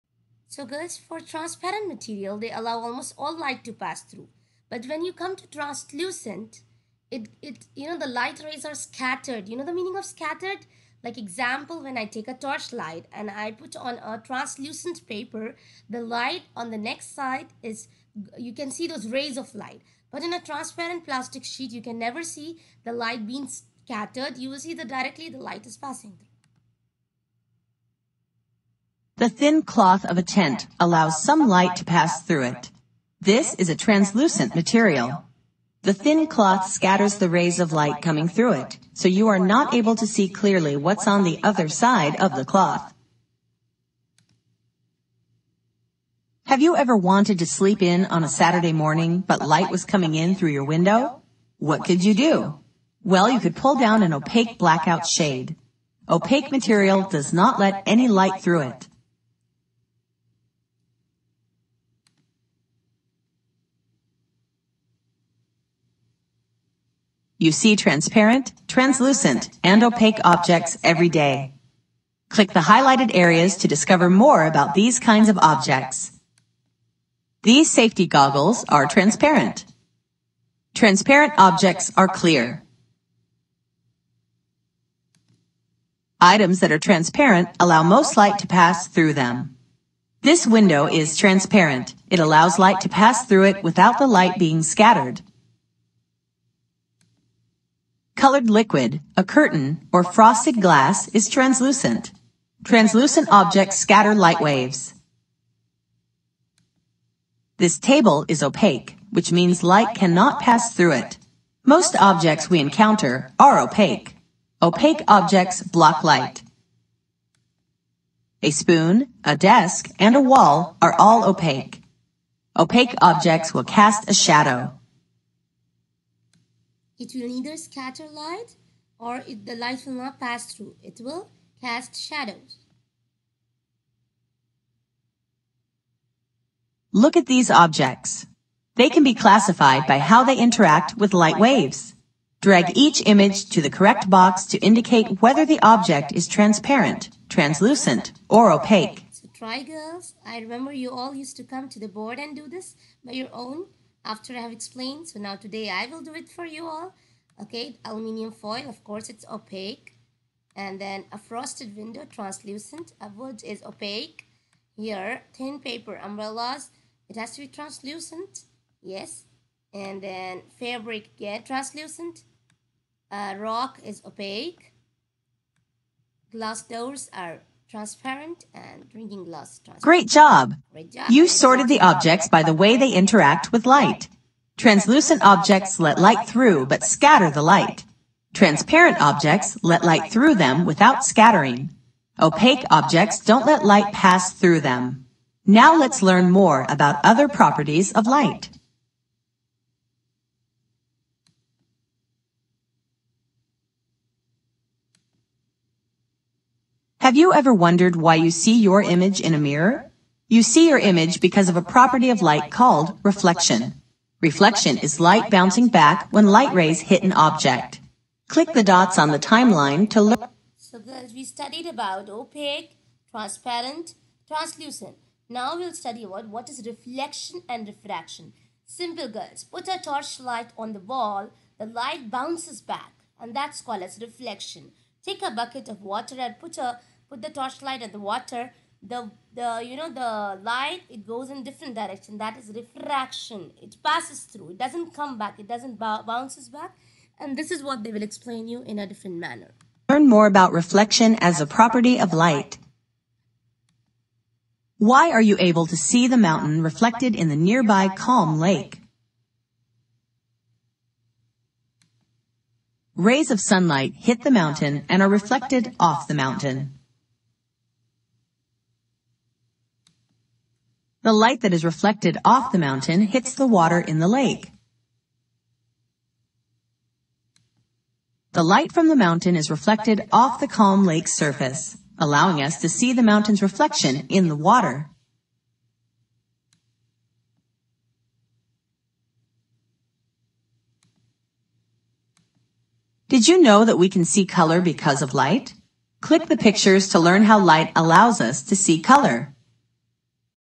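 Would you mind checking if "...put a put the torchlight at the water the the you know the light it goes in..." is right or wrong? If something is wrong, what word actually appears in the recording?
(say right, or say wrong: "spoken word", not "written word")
right.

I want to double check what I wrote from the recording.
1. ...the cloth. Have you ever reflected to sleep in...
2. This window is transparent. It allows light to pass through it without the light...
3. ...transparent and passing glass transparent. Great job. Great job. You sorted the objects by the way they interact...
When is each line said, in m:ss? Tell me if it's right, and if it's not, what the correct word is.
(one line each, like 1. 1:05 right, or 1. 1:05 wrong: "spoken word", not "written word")
1. 0:42 wrong: "wanted", not "reflected"
2. 1:30 right
3. 2:57 wrong: "drinking", not "passing".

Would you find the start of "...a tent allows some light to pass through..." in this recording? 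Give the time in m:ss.
0:30.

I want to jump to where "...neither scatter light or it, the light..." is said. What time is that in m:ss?
2:07.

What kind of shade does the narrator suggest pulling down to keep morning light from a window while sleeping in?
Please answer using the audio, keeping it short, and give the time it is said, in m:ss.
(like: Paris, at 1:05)
opaque blackout shade, at 0:54.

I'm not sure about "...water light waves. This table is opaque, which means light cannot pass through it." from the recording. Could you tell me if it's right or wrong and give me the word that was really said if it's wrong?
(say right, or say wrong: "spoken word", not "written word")
wrong: "scatter", not "water".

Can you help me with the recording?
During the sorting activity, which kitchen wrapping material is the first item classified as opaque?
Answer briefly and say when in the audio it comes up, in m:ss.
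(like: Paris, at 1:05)
aluminium foil, at 2:37.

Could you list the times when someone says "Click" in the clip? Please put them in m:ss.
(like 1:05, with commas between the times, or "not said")
1:12, 3:38, 4:56.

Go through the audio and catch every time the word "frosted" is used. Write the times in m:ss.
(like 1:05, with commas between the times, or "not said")
1:40, 2:41.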